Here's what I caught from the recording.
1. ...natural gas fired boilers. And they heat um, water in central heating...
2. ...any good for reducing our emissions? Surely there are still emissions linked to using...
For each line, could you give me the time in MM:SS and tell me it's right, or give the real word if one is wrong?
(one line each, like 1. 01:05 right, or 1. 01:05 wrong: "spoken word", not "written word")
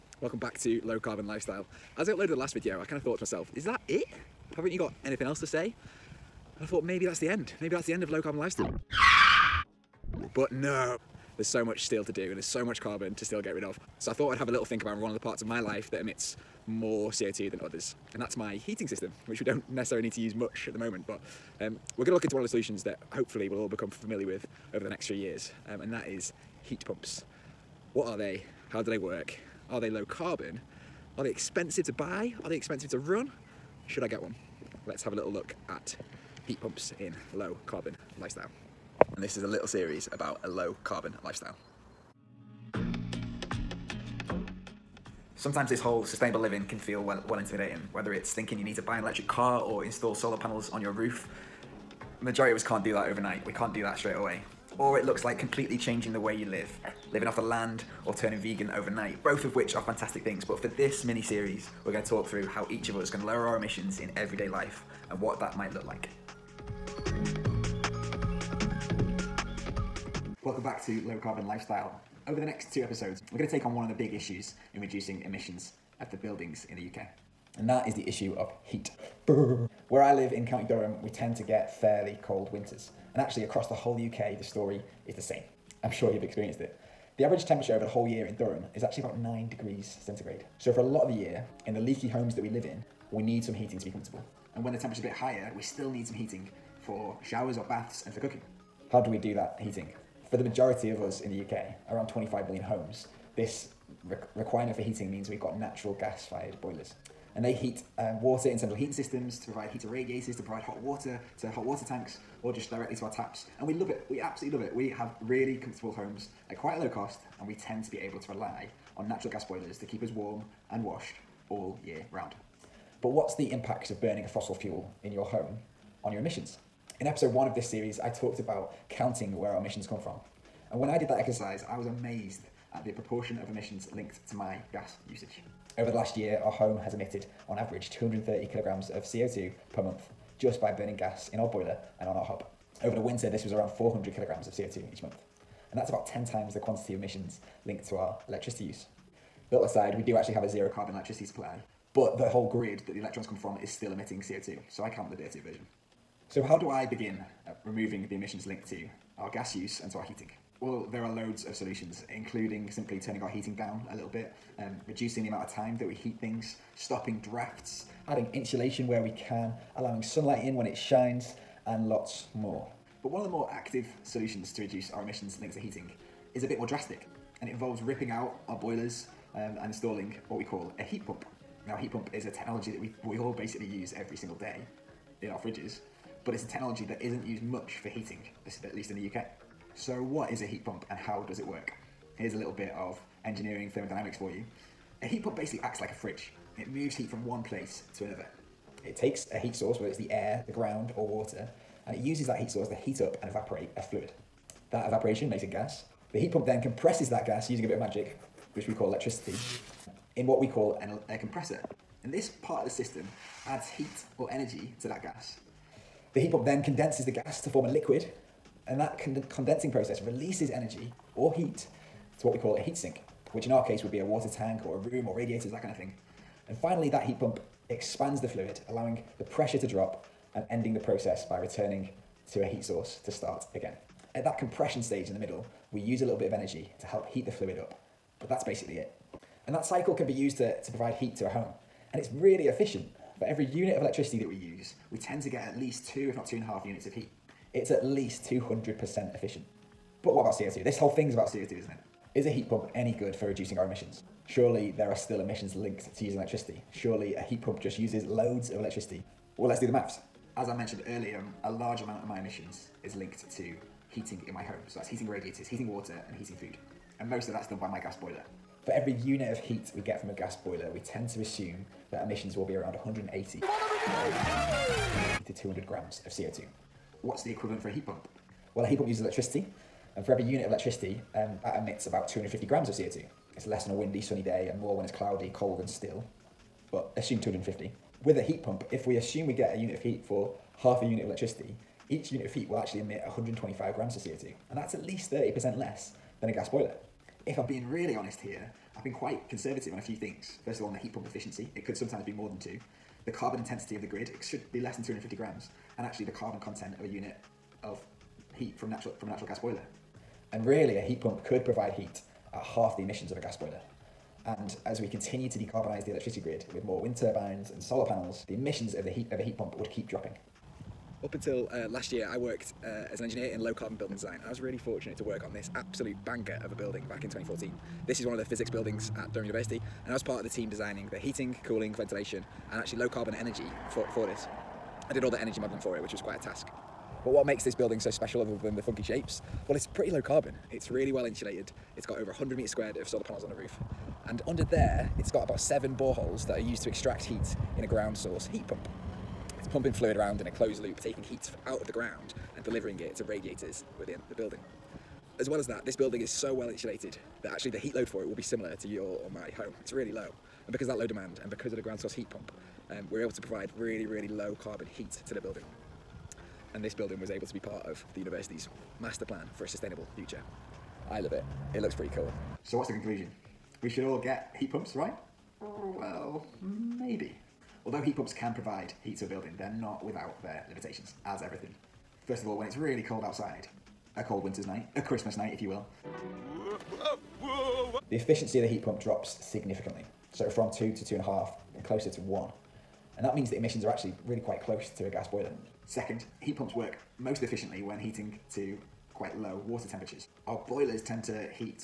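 1. 01:45 right
2. 04:12 right.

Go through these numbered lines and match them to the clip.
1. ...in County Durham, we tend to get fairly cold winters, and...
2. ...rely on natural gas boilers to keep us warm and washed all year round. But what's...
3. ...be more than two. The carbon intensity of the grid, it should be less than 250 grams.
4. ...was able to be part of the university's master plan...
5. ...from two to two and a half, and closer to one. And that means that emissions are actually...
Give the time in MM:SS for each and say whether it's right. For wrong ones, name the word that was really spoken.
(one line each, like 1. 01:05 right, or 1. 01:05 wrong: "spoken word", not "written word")
1. 01:20 right
2. 01:58 right
3. 05:02 right
4. 06:06 right
5. 06:30 right.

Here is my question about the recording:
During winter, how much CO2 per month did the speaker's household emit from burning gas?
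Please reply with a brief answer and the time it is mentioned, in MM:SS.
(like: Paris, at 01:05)
400 kilograms, at 02:23.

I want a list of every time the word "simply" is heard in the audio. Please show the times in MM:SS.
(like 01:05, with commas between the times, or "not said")
02:42.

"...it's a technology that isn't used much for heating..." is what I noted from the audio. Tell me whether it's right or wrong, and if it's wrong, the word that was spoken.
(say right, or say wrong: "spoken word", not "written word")
right.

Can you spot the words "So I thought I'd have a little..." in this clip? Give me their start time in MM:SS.
00:13.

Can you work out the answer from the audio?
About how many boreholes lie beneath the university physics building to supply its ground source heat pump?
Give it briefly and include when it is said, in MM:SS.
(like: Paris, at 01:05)
7, at 05:45.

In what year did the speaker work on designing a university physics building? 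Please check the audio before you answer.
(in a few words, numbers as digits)
2014.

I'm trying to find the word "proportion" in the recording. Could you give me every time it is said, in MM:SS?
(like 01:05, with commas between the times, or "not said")
02:12.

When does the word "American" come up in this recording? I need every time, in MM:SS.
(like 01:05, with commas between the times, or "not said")
not said.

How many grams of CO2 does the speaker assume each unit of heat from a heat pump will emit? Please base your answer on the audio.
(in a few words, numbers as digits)
125 grams.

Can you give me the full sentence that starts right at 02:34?
So I count the dirtier version.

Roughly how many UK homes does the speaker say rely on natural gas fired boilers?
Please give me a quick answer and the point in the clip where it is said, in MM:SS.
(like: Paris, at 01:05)
25 million, at 01:42.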